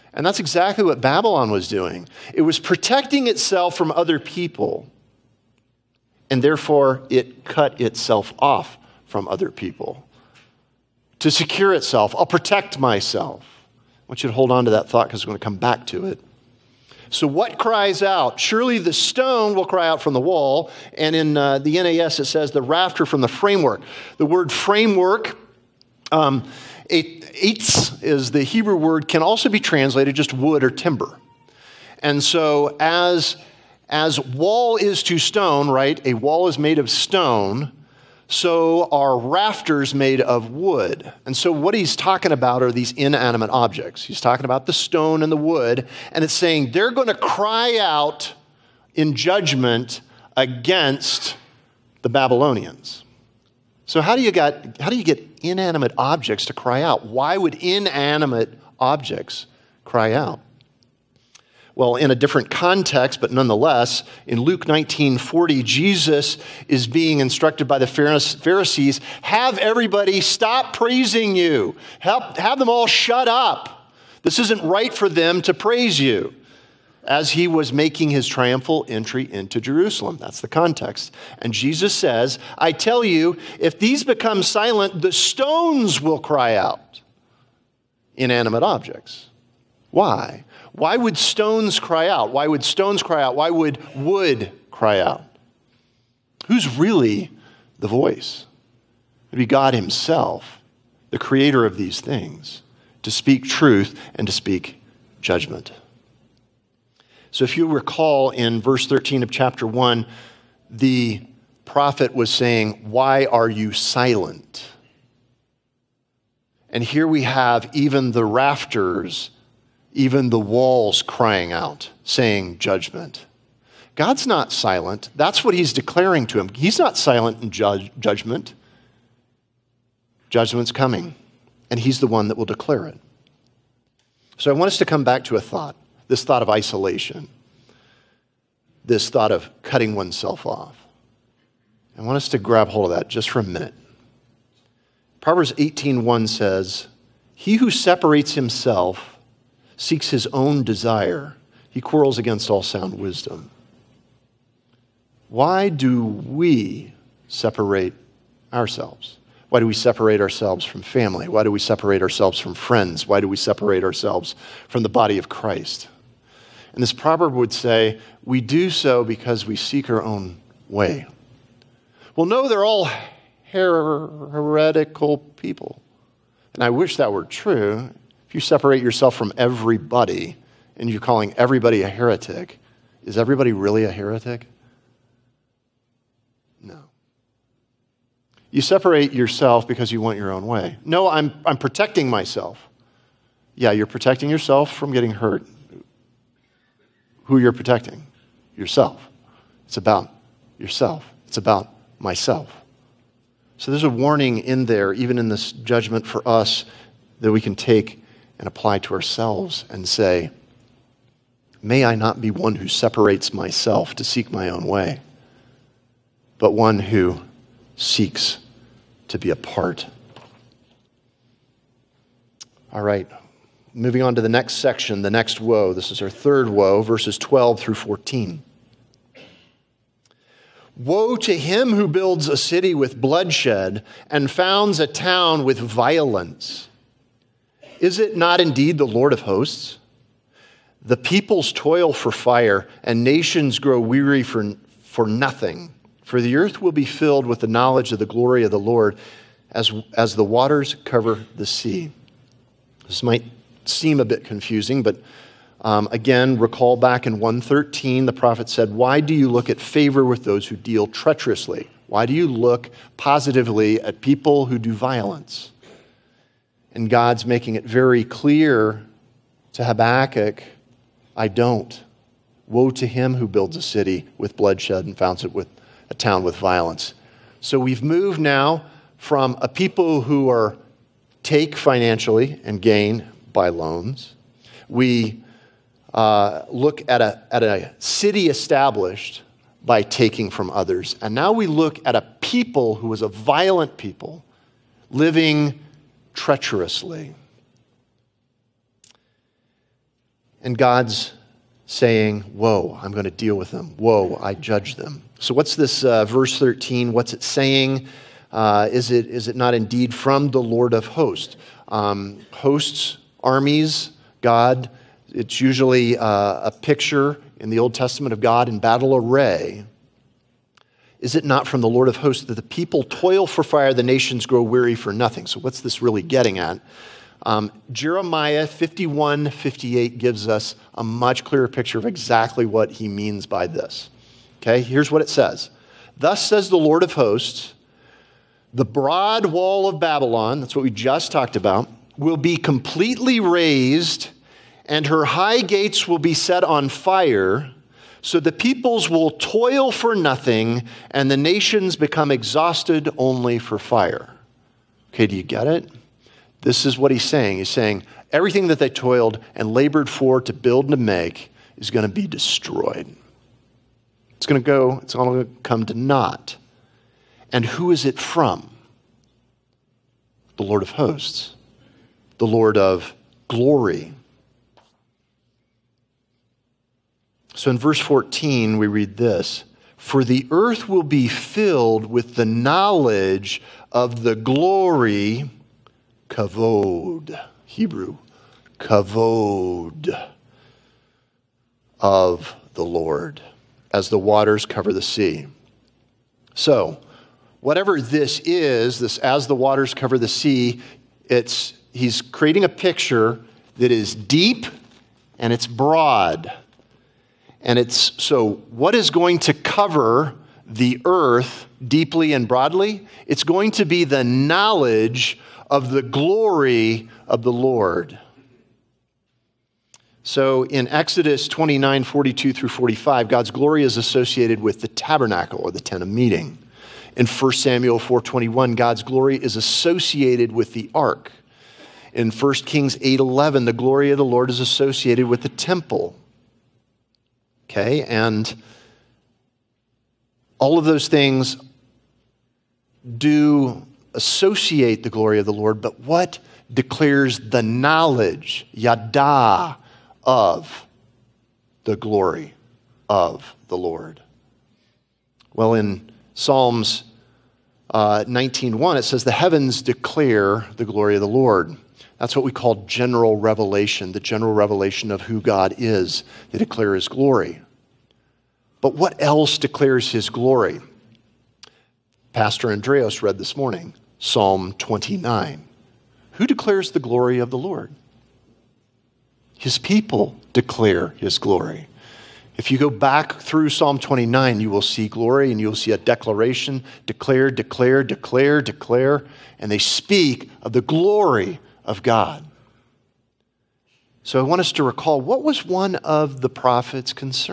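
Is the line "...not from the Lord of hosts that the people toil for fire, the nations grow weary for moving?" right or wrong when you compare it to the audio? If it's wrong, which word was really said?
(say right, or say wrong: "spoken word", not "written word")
wrong: "nothing", not "moving".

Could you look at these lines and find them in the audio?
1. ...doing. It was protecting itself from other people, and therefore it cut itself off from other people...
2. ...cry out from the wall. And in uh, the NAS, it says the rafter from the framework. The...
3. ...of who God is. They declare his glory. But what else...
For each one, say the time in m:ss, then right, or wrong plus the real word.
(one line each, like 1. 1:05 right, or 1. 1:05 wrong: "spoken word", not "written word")
1. 0:01 right
2. 0:19 right
3. 7:44 right.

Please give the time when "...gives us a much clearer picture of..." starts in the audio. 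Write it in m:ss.
5:29.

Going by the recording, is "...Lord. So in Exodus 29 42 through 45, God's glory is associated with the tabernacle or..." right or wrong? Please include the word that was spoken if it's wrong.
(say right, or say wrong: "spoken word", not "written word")
right.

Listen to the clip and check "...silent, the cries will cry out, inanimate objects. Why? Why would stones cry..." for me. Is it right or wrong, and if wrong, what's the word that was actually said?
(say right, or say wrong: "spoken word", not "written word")
wrong: "stones", not "cries".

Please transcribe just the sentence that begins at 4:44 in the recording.
We uh, look at a, at a city established by taking from others.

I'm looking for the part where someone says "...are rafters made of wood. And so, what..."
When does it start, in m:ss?
0:38.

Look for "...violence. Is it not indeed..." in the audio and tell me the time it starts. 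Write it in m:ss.
3:55.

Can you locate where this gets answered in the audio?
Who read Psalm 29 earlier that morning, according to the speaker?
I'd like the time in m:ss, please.
7:52.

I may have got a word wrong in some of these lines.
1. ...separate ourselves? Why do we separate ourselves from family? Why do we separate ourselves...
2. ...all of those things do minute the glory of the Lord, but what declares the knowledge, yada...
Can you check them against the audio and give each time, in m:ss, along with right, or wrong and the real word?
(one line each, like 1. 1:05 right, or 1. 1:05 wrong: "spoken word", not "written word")
1. 2:37 right
2. 7:20 wrong: "associate", not "minute".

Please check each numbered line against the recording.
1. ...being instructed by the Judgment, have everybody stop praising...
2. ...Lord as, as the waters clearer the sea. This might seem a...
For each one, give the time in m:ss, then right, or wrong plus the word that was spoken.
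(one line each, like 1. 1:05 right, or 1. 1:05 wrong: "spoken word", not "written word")
1. 1:06 wrong: "Pharisees", not "Judgment"
2. 4:08 wrong: "cover", not "clearer".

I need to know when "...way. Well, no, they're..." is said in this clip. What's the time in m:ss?
2:50.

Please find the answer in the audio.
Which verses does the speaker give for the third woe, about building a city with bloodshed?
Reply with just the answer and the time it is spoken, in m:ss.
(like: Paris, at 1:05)
12 through 14, at 3:46.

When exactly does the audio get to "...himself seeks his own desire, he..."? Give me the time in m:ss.
2:28.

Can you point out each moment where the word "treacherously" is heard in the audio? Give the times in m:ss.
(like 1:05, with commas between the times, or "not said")
4:20, 4:56.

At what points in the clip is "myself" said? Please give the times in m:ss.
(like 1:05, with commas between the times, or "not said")
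0:12, 3:12, 3:21, 3:33.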